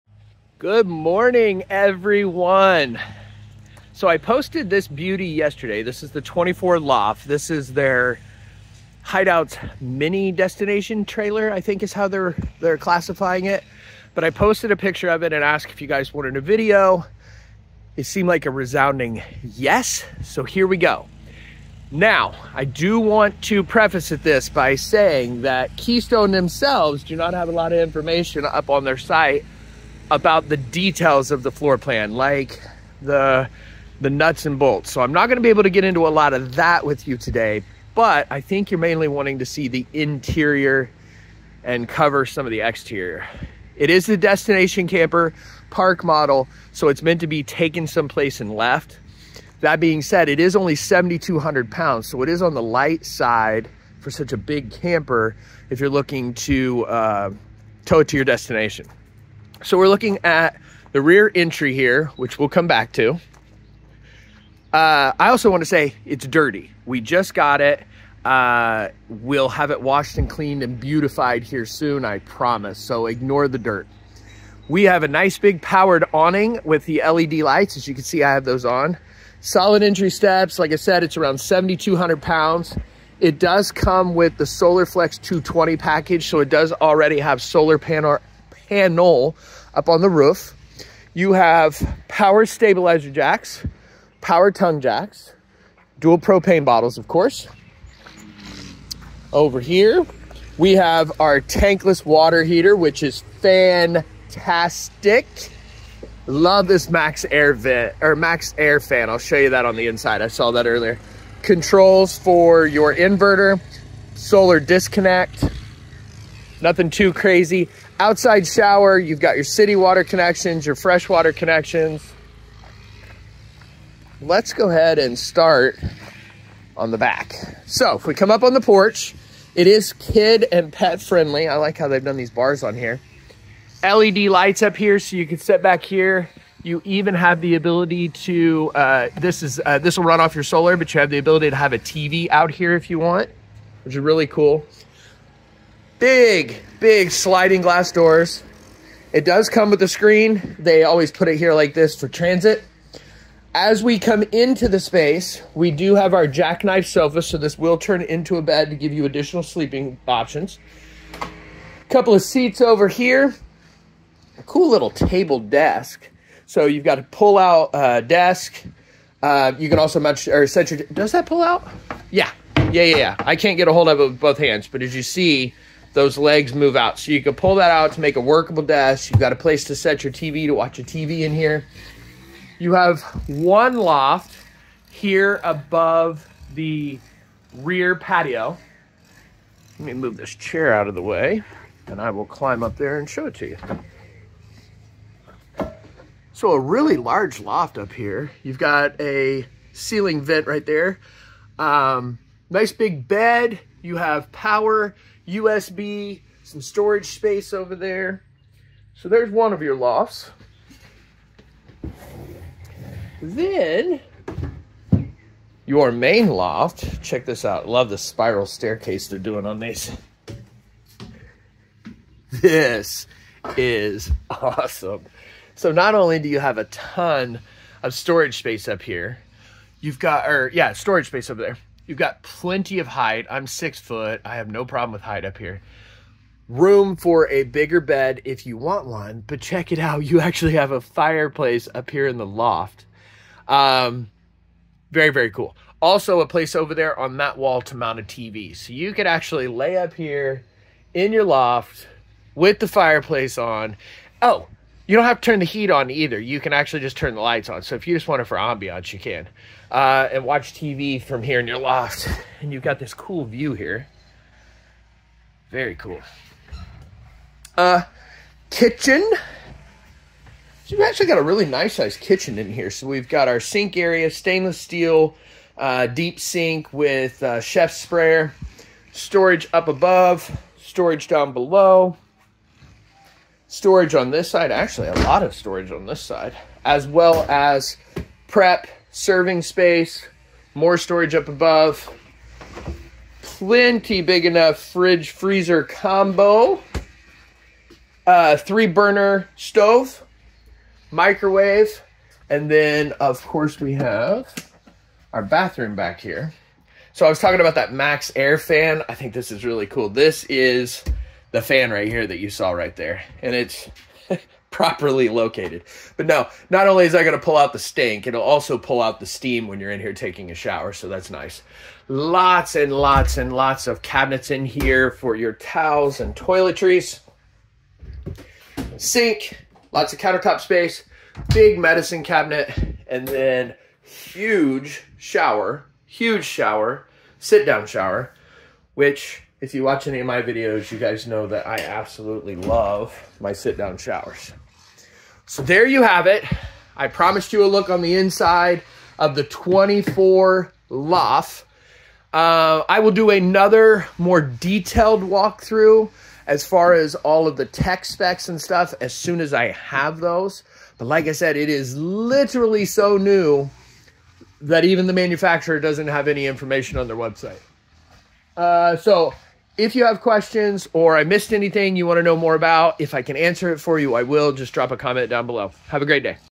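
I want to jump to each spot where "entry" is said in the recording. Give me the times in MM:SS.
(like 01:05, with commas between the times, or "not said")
01:01, 01:19.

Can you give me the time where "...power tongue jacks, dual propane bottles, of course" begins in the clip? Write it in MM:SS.
01:34.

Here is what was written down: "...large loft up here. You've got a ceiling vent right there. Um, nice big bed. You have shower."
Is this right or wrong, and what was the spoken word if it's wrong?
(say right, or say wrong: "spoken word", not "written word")
wrong: "power", not "shower".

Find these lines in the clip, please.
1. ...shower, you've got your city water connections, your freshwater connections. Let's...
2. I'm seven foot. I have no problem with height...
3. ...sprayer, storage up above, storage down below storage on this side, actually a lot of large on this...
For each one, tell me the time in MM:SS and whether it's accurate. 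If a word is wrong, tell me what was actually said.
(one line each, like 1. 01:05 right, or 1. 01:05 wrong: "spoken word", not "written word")
1. 01:58 right
2. 03:53 wrong: "six", not "seven"
3. 04:37 wrong: "storage", not "large".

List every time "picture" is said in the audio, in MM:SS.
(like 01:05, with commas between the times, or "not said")
00:14.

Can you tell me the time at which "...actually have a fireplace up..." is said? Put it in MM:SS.
04:00.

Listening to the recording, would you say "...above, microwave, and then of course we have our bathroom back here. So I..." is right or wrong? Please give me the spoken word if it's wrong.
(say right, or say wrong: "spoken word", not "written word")
wrong: "stove", not "above".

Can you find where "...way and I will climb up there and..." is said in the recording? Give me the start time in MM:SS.
03:11.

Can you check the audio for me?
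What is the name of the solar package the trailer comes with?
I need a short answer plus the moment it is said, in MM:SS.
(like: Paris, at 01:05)
Solar Flex 220, at 01:24.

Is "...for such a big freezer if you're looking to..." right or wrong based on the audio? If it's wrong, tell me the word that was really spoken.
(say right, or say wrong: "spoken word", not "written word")
wrong: "camper", not "freezer".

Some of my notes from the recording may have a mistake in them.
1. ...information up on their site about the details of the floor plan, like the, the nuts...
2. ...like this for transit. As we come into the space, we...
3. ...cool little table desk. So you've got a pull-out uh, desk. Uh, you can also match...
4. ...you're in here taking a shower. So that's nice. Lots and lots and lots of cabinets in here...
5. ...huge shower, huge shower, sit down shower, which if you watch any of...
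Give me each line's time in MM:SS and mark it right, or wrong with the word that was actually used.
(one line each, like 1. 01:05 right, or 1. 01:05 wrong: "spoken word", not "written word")
1. 00:27 right
2. 02:31 right
3. 02:44 right
4. 05:19 right
5. 05:33 right.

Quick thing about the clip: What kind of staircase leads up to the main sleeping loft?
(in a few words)
Spiral staircase.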